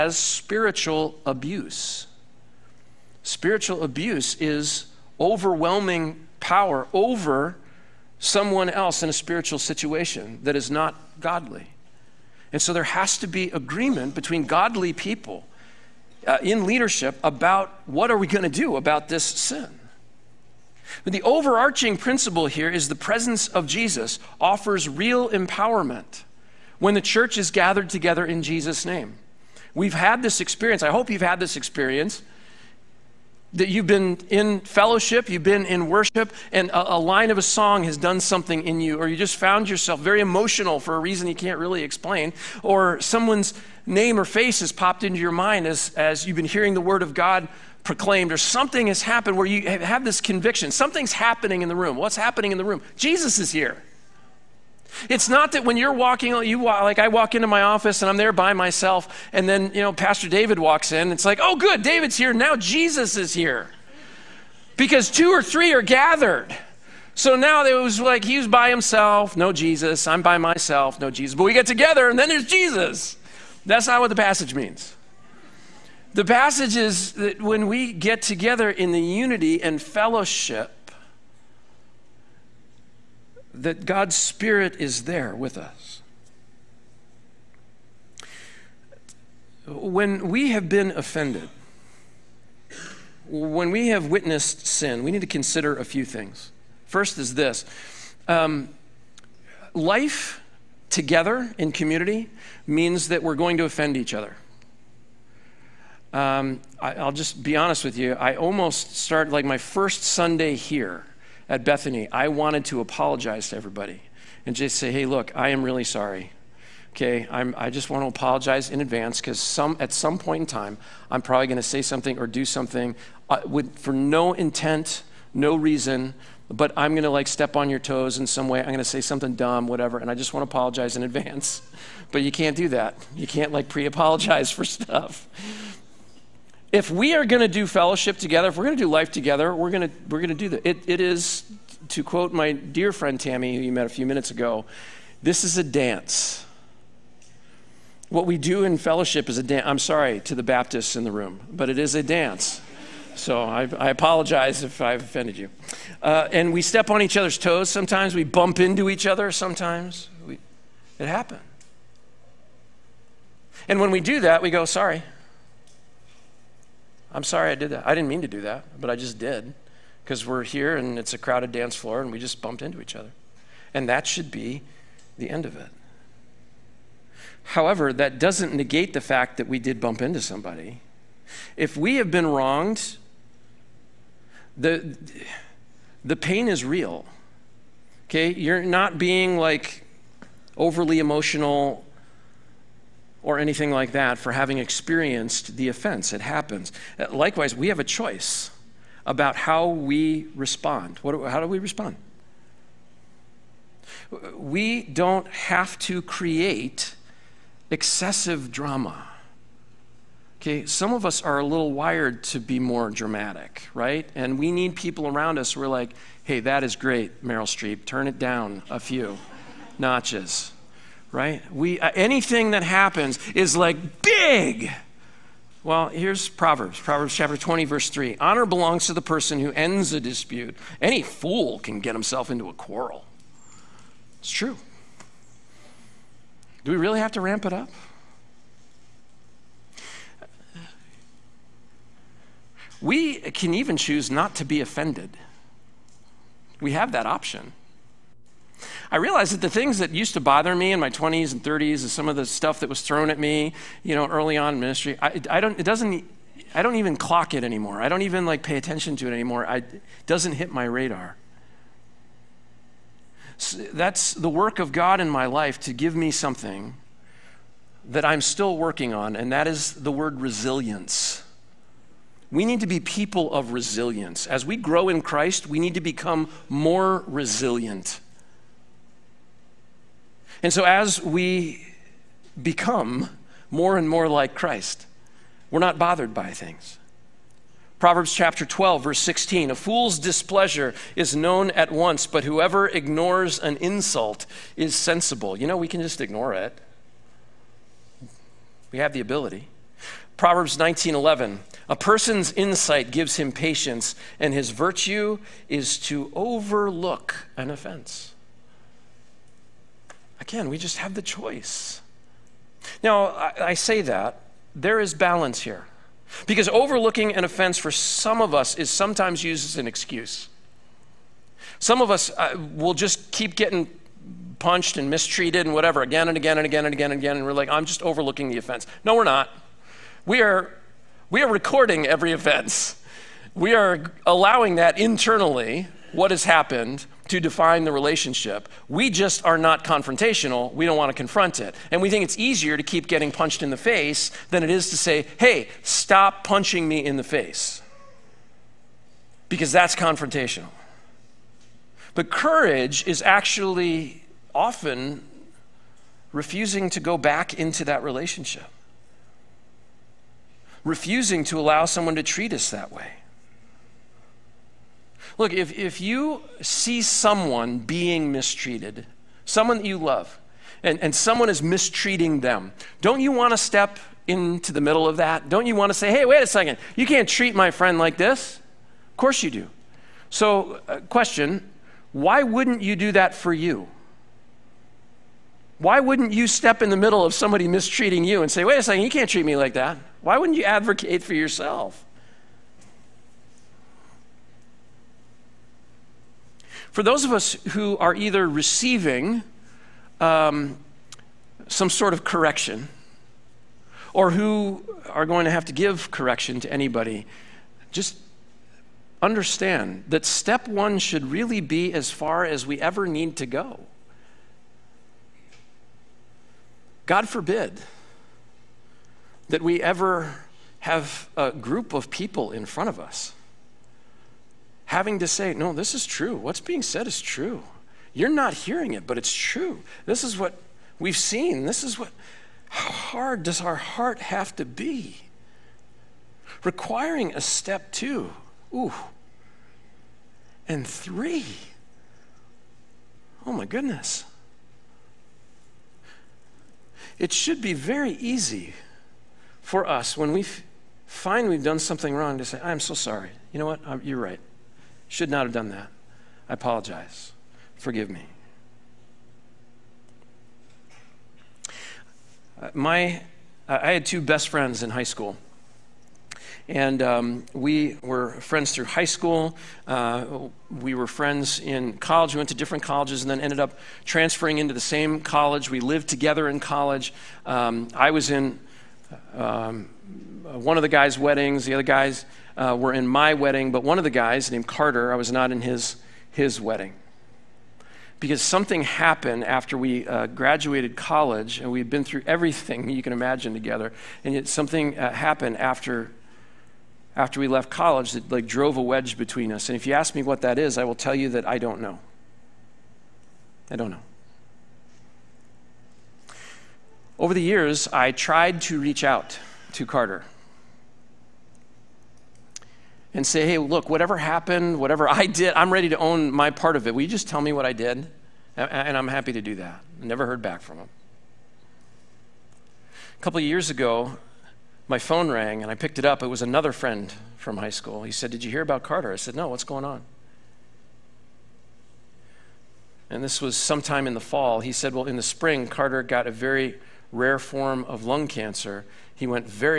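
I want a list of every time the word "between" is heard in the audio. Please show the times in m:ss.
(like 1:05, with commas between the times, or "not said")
0:14, 8:18.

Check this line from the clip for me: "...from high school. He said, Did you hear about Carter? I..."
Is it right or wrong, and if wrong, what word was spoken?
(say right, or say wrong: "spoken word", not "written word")
right.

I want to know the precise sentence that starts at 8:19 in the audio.
And if you ask me what that is, I will tell you that I don't know.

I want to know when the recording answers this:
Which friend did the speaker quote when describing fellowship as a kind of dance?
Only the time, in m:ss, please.
2:23.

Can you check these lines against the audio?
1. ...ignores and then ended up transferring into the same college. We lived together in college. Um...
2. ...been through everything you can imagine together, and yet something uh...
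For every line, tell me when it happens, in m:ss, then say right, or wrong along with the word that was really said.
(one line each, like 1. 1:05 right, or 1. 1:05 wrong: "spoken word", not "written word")
1. 7:52 wrong: "colleges", not "ignores"
2. 8:11 right.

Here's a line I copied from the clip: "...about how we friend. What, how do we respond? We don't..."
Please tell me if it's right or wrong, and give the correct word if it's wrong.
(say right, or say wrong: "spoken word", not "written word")
wrong: "respond", not "friend".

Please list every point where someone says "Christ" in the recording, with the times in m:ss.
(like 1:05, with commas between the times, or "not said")
4:35, 4:44.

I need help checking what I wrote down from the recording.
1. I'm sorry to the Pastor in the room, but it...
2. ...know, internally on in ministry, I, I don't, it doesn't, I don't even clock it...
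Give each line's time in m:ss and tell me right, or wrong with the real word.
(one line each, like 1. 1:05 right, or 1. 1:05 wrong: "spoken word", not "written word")
1. 2:29 wrong: "Baptists", not "Pastor"
2. 4:13 wrong: "early", not "internally".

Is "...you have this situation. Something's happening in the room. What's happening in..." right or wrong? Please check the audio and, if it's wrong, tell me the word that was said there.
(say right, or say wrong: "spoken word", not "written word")
wrong: "conviction", not "situation".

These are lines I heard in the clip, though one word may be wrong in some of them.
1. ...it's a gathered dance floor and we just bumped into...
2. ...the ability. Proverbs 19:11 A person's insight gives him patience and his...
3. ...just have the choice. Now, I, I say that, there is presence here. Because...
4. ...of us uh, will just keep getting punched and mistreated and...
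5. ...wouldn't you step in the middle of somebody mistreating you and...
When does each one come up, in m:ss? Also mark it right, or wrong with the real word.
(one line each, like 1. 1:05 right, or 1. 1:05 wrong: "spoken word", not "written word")
1. 2:50 wrong: "crowded", not "gathered"
2. 4:58 right
3. 5:10 wrong: "balance", not "presence"
4. 5:21 right
5. 6:25 right.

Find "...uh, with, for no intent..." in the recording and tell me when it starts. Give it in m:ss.
2:03.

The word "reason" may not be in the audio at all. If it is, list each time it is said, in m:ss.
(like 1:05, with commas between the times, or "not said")
0:40, 2:05.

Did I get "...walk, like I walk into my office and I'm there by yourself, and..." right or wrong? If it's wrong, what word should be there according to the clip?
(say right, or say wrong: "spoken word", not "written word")
wrong: "myself", not "yourself".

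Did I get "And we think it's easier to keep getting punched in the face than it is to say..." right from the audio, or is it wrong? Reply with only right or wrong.
right.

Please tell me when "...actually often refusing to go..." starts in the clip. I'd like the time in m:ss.
5:53.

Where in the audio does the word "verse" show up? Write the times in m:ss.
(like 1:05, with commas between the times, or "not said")
3:47, 4:48.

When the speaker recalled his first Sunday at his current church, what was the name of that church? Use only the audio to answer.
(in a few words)
Bethany.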